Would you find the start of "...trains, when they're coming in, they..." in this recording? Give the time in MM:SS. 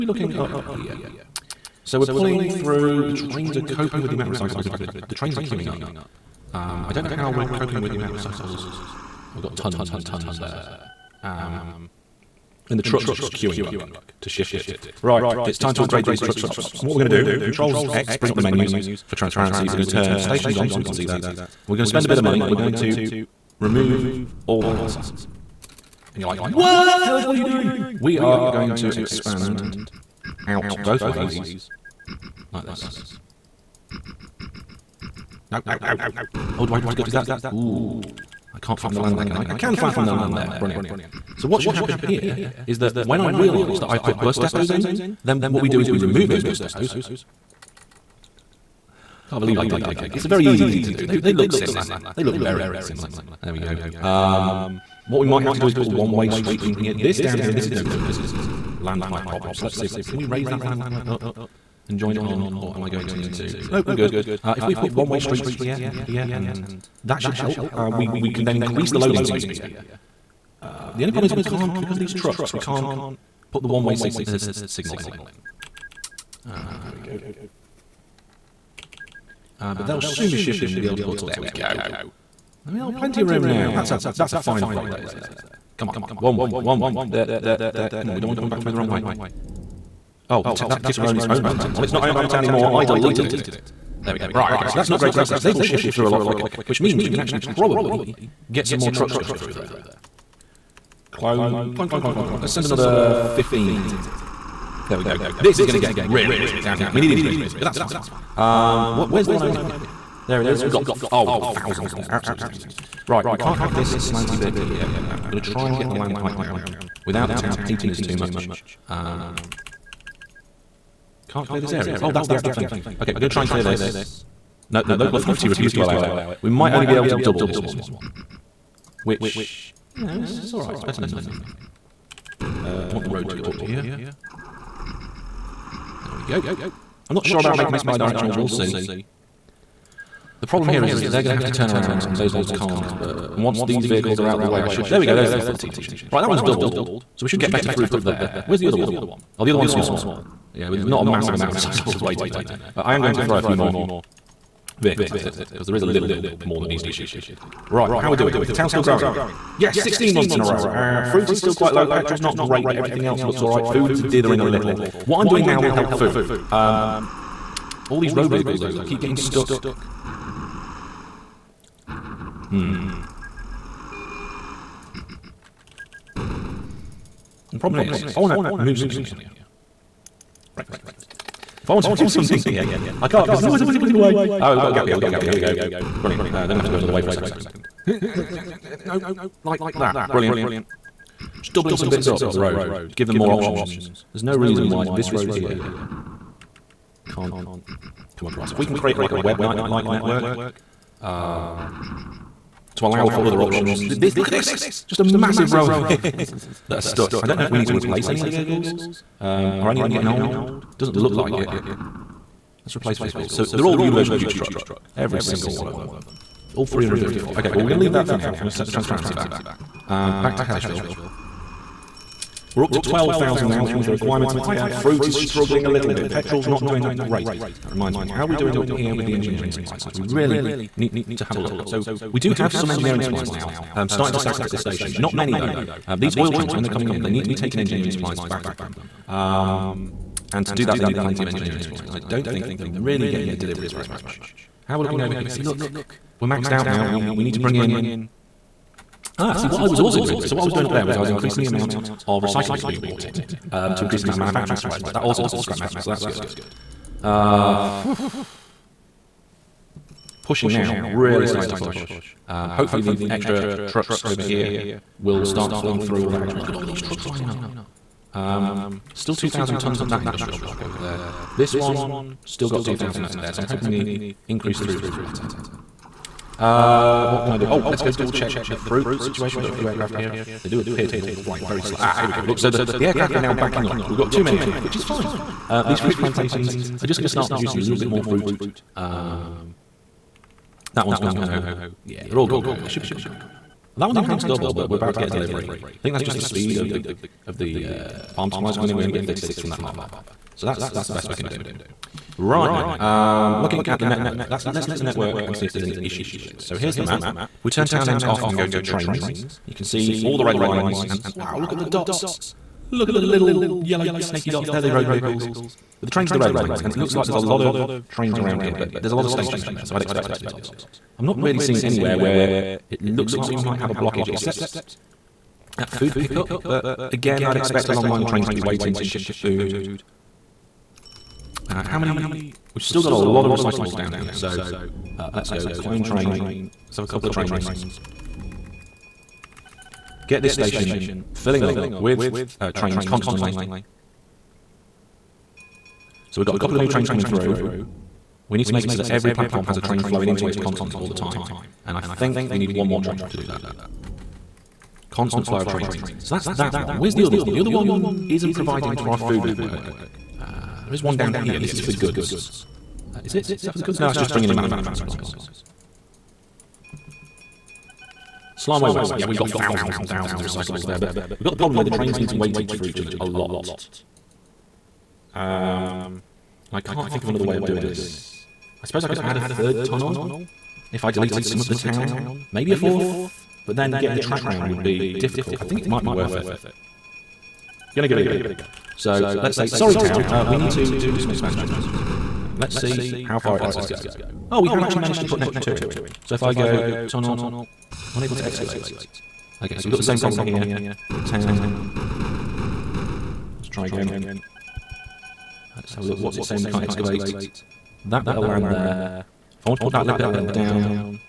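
03:56.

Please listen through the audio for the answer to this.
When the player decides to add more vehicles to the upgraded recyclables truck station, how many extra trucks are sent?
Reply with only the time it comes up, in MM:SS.
01:43.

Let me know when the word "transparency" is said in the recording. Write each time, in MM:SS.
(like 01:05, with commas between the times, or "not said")
00:19, 03:38.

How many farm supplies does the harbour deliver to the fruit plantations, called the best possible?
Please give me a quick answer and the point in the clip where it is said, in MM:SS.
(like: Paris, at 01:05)
36, at 04:59.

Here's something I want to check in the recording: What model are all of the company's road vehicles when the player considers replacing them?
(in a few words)
Universal Future Truck.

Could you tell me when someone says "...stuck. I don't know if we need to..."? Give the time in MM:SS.
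03:26.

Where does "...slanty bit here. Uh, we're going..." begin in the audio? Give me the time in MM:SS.
01:53.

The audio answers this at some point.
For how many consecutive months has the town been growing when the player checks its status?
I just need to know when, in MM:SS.
02:39.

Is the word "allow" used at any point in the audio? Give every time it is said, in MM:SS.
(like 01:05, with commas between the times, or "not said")
02:05, 03:22.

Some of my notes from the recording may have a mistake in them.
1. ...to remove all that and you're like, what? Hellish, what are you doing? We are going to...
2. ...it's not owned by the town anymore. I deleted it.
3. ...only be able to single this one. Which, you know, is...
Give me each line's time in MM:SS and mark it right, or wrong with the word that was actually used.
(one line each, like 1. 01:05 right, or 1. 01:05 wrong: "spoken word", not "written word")
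1. 00:22 right
2. 01:31 right
3. 02:06 wrong: "double", not "single".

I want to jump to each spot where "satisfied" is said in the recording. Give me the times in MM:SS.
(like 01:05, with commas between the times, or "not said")
not said.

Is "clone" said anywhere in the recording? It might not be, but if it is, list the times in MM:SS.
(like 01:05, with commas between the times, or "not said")
01:41, 05:35.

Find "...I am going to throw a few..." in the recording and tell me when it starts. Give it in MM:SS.
02:32.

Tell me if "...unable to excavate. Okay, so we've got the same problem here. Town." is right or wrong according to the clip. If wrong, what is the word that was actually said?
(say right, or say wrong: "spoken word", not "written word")
right.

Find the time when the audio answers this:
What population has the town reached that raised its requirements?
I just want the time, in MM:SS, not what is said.
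03:42.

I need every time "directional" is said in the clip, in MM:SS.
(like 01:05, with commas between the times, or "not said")
02:17.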